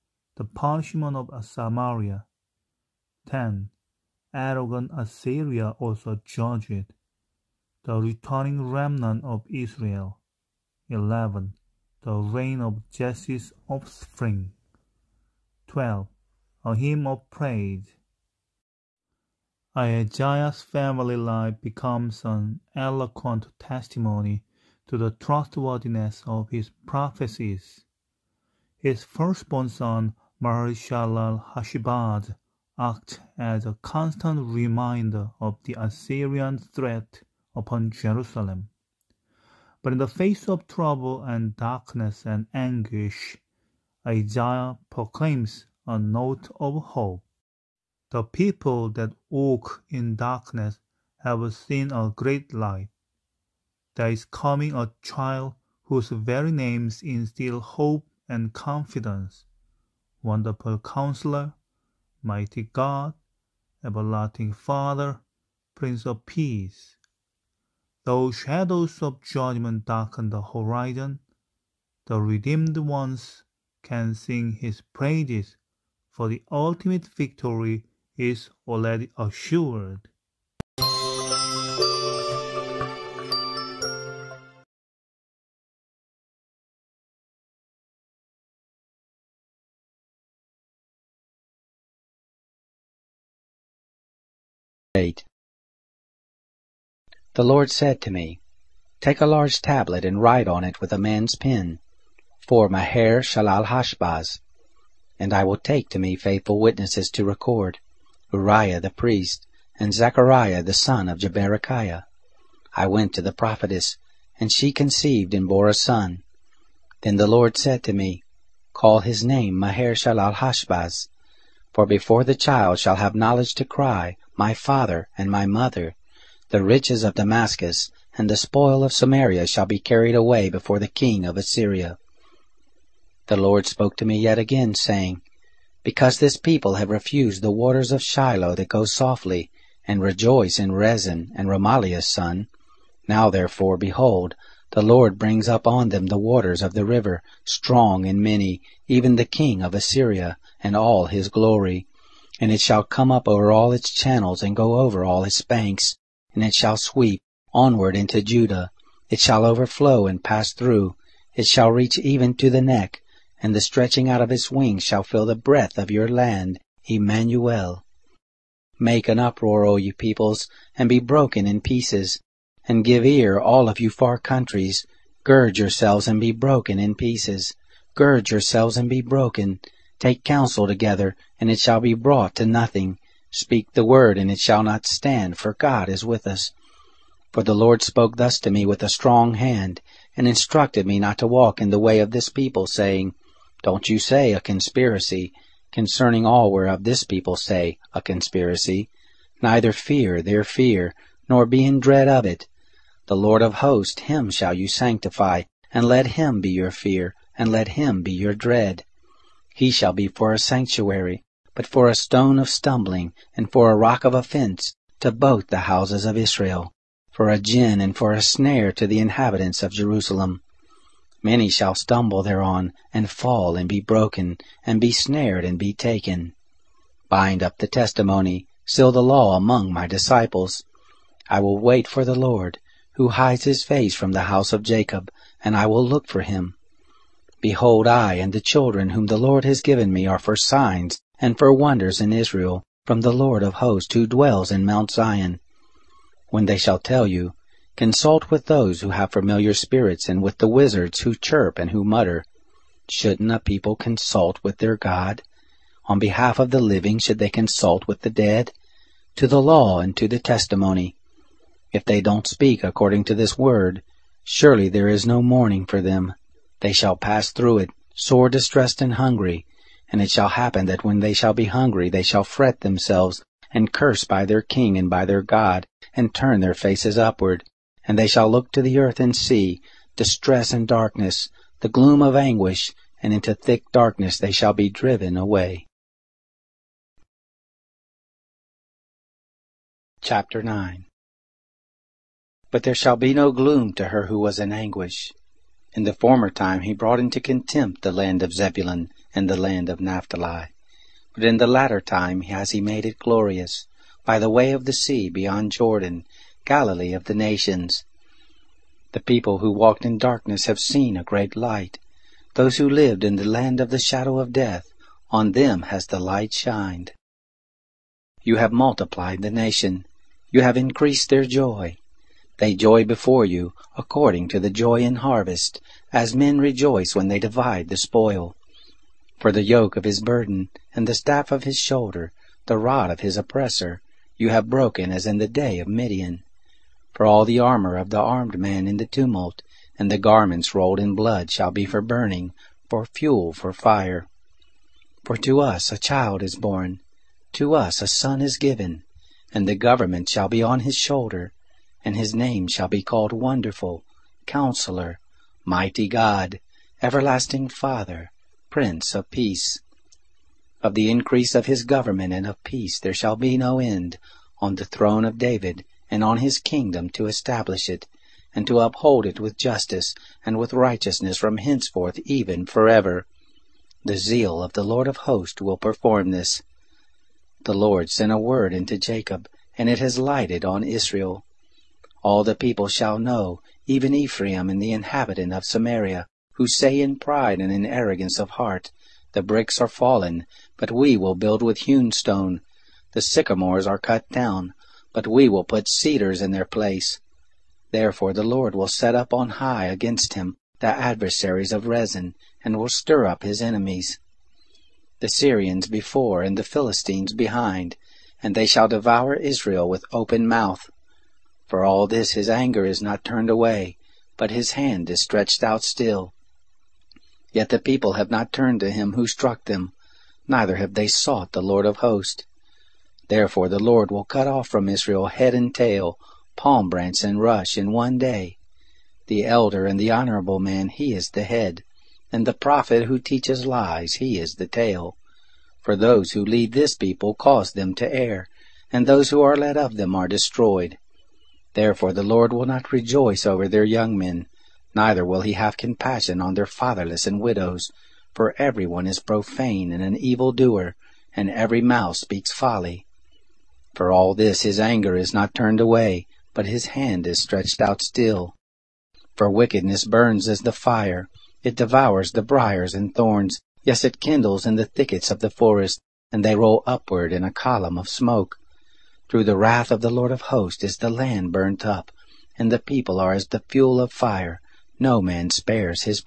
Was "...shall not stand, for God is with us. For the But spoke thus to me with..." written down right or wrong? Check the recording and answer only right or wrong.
wrong.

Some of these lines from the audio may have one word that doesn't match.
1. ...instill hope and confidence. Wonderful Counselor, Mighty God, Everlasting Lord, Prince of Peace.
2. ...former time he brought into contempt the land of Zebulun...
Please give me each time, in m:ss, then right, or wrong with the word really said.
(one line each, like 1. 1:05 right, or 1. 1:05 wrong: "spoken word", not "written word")
1. 0:57 wrong: "Father", not "Lord"
2. 4:55 right.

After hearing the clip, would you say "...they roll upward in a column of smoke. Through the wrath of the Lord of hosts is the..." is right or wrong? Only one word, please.
right.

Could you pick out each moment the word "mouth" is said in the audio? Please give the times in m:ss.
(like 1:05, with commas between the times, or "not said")
6:50, 7:31.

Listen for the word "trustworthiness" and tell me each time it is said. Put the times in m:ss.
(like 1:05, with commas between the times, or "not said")
0:25.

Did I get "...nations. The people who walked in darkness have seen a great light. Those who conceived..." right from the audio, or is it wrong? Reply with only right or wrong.
wrong.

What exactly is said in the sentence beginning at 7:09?
The elder and the honorable man, he is the head, and the prophet who teaches lies, he is the tail.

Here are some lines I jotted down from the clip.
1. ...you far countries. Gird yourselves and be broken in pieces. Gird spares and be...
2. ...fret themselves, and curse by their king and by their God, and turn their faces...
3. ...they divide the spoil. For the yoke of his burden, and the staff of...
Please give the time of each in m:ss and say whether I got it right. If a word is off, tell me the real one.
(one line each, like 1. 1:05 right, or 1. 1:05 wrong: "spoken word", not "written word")
1. 2:53 wrong: "yourselves", not "spares"
2. 4:32 right
3. 5:27 right.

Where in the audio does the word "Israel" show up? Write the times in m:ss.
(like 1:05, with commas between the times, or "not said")
0:09, 3:36, 4:02, 6:20, 6:49, 7:04.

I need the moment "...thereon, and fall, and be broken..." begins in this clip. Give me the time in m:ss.
3:42.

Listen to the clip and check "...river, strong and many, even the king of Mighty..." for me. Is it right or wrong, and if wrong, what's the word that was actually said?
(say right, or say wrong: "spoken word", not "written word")
wrong: "Assyria", not "Mighty".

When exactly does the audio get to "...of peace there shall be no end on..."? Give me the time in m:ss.
6:02.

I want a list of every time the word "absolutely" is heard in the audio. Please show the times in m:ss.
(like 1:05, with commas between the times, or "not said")
not said.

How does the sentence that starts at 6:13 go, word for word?
The zeal of the Lord of hosts will perform this.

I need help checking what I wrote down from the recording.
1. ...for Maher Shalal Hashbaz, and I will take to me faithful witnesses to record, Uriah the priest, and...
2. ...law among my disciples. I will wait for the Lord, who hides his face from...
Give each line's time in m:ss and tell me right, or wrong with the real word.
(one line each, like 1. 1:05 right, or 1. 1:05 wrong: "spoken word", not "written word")
1. 1:42 right
2. 3:49 right.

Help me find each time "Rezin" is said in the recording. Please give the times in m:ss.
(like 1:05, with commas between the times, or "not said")
2:20, 6:41.